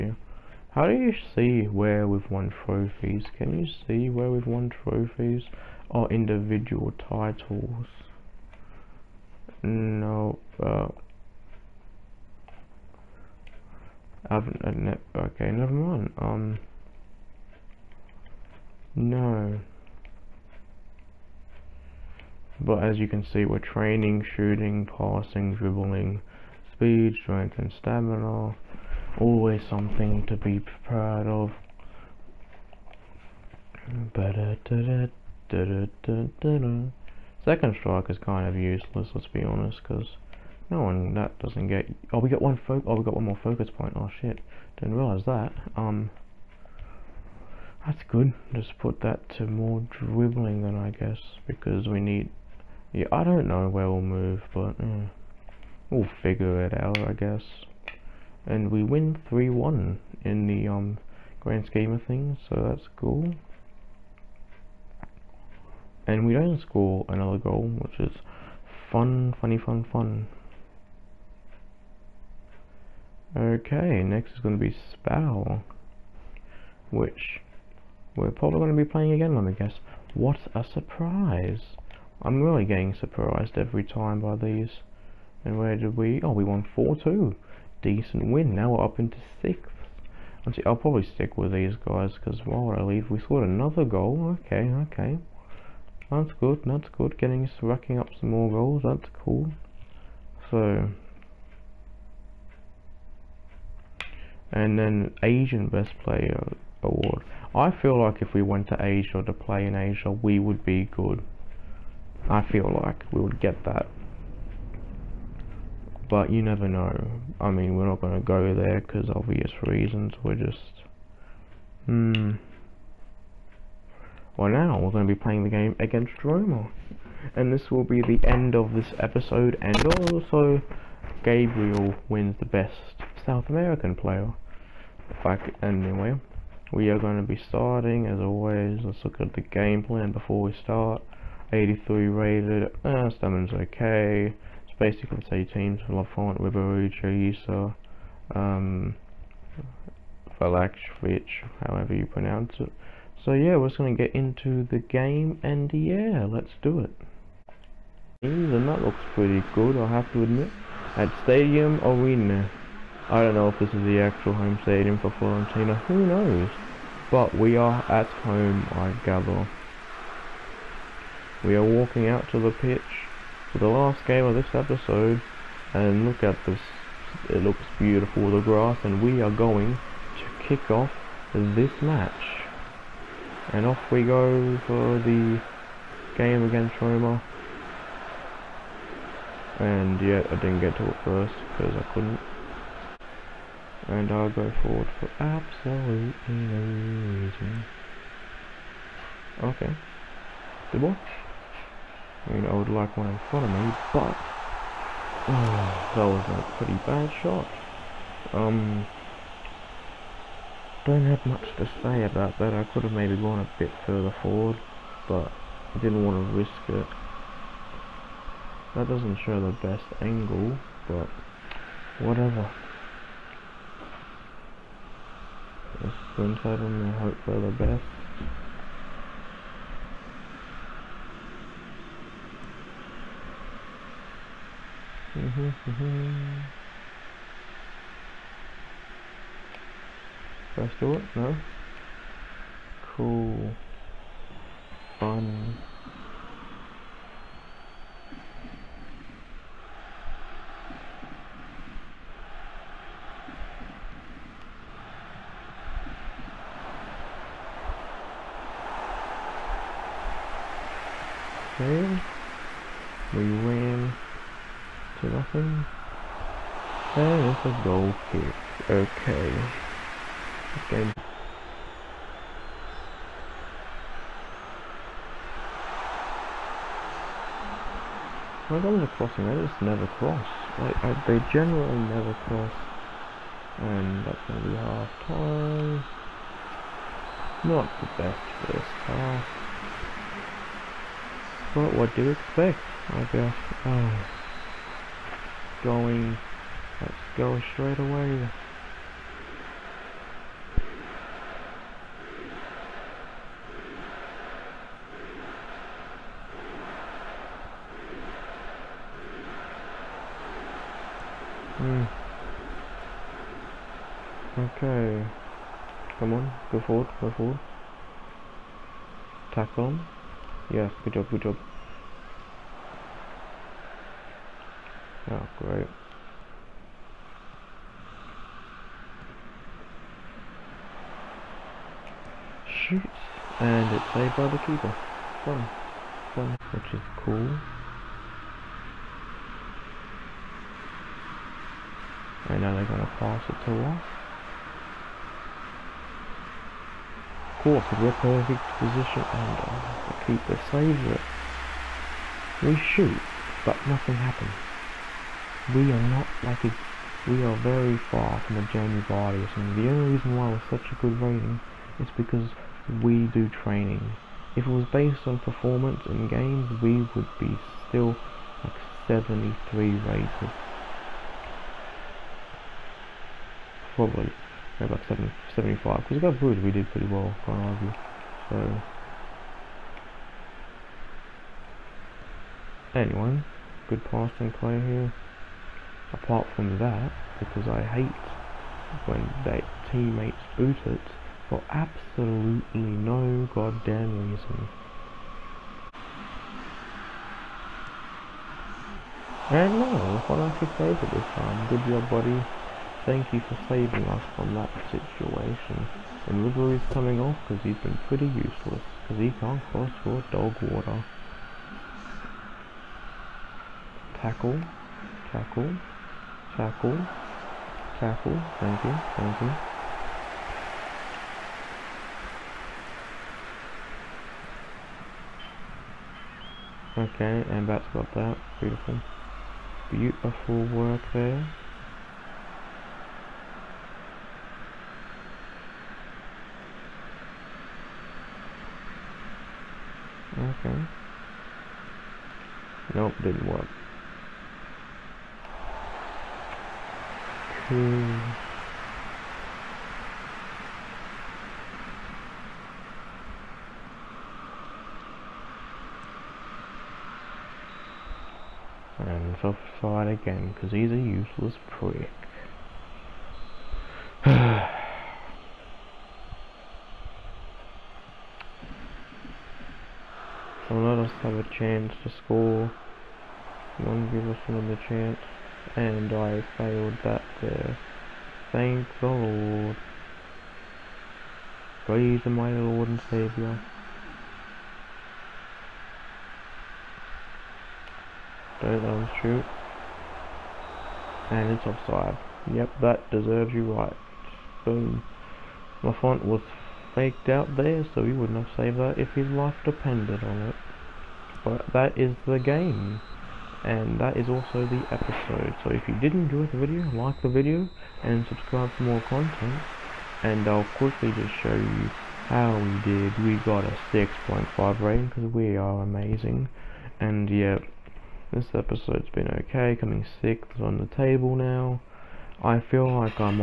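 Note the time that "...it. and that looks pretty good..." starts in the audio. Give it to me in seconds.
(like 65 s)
156 s.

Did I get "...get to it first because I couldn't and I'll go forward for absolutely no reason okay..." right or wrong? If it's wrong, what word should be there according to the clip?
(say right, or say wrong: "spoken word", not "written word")
right.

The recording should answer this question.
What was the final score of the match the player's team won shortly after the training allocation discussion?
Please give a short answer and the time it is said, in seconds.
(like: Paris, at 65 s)
3-1, at 59 s.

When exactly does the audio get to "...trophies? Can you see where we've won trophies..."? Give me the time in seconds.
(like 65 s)
2 s.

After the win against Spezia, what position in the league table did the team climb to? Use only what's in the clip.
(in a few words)
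6th.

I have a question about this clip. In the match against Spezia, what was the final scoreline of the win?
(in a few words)
4-2.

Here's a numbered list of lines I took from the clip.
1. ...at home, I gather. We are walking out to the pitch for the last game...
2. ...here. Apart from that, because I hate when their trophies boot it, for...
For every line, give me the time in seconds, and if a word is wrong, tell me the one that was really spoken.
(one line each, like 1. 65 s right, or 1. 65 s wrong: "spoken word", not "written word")
1. 167 s right
2. 384 s wrong: "teammates", not "trophies".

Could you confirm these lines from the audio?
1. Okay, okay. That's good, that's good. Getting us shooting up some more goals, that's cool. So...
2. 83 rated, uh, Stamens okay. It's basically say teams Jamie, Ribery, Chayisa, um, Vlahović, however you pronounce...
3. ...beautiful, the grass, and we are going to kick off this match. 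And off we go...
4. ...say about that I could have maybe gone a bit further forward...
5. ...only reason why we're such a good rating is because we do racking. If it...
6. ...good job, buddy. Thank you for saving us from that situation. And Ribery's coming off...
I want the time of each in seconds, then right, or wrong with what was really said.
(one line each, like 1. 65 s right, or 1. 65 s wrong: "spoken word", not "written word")
1. 94 s wrong: "racking", not "shooting"
2. 141 s wrong: "Lafont", not "Jamie"
3. 177 s right
4. 211 s right
5. 359 s wrong: "training", not "racking"
6. 401 s right.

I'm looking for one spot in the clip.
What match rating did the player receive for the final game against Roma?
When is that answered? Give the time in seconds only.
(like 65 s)
513 s.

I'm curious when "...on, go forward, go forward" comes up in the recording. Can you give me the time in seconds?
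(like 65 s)
316 s.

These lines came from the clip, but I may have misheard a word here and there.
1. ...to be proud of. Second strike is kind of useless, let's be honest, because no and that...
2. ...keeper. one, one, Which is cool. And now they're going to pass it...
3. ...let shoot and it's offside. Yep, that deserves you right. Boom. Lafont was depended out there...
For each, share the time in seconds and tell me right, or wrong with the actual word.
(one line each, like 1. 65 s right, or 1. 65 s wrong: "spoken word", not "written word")
1. 30 s right
2. 334 s right
3. 488 s wrong: "faked", not "depended".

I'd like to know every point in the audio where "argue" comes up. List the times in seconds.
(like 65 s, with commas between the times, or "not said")
377 s.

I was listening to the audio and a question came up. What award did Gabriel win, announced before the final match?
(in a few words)
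Best South American player.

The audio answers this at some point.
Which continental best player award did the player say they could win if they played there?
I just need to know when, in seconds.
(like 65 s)
105 s.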